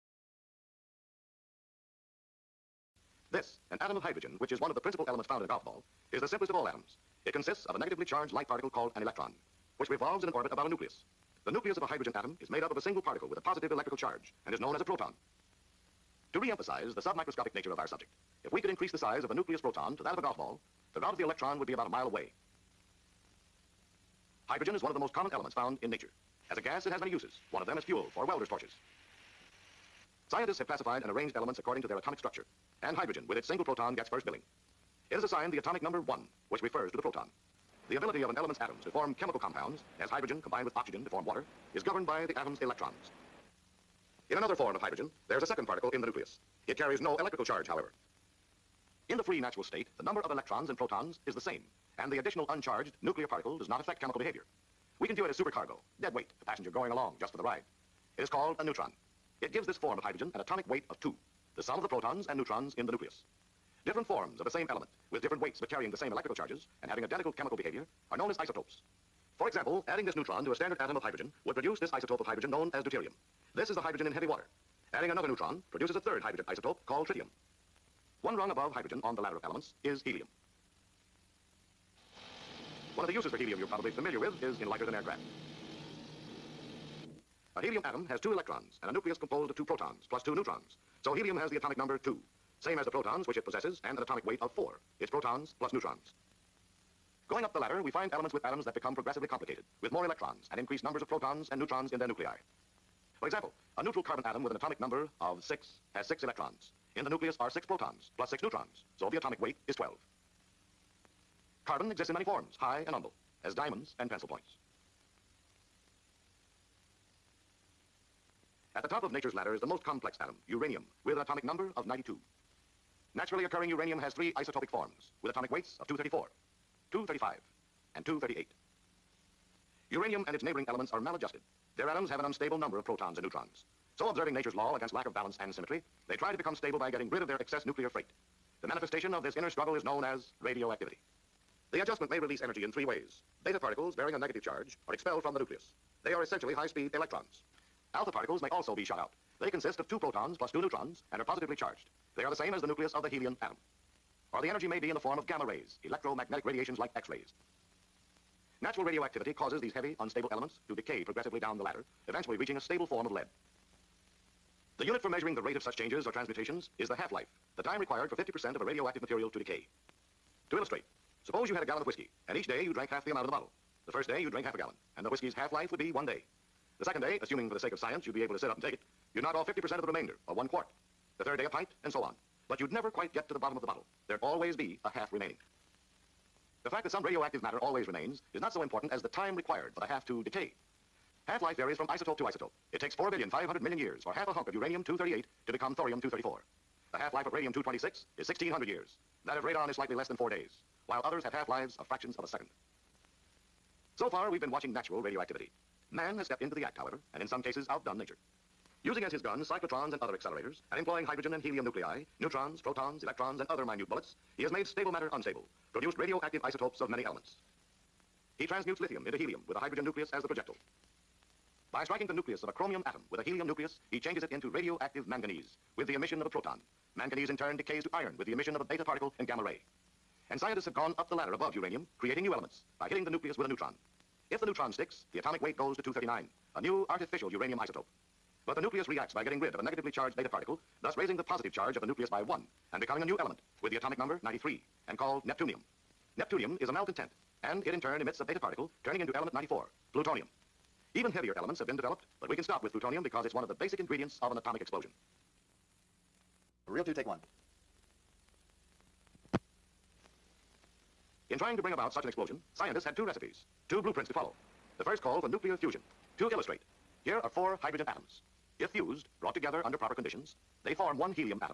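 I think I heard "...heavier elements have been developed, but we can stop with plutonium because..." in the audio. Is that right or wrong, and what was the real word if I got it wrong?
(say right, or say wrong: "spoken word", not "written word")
right.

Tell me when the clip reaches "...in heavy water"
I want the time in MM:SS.
01:14.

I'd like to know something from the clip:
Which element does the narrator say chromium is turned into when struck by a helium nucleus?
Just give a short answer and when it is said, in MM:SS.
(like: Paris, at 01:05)
radioactive manganese, at 03:44.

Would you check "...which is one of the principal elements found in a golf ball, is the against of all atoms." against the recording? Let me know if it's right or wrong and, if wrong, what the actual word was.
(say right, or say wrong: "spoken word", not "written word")
wrong: "simplest", not "against".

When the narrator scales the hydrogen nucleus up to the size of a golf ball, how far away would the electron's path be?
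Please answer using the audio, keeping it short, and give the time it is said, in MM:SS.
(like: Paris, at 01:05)
about a mile, at 00:21.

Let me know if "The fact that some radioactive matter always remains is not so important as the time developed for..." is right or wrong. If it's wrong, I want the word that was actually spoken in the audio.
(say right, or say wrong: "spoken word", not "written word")
wrong: "required", not "developed".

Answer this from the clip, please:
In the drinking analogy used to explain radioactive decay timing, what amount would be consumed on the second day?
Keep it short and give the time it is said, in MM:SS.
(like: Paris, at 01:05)
one quart, at 03:00.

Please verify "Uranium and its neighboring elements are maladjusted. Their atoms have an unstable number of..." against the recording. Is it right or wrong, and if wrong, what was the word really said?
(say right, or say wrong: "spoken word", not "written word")
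right.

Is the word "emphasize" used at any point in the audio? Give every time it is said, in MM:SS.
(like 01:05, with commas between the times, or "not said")
00:16.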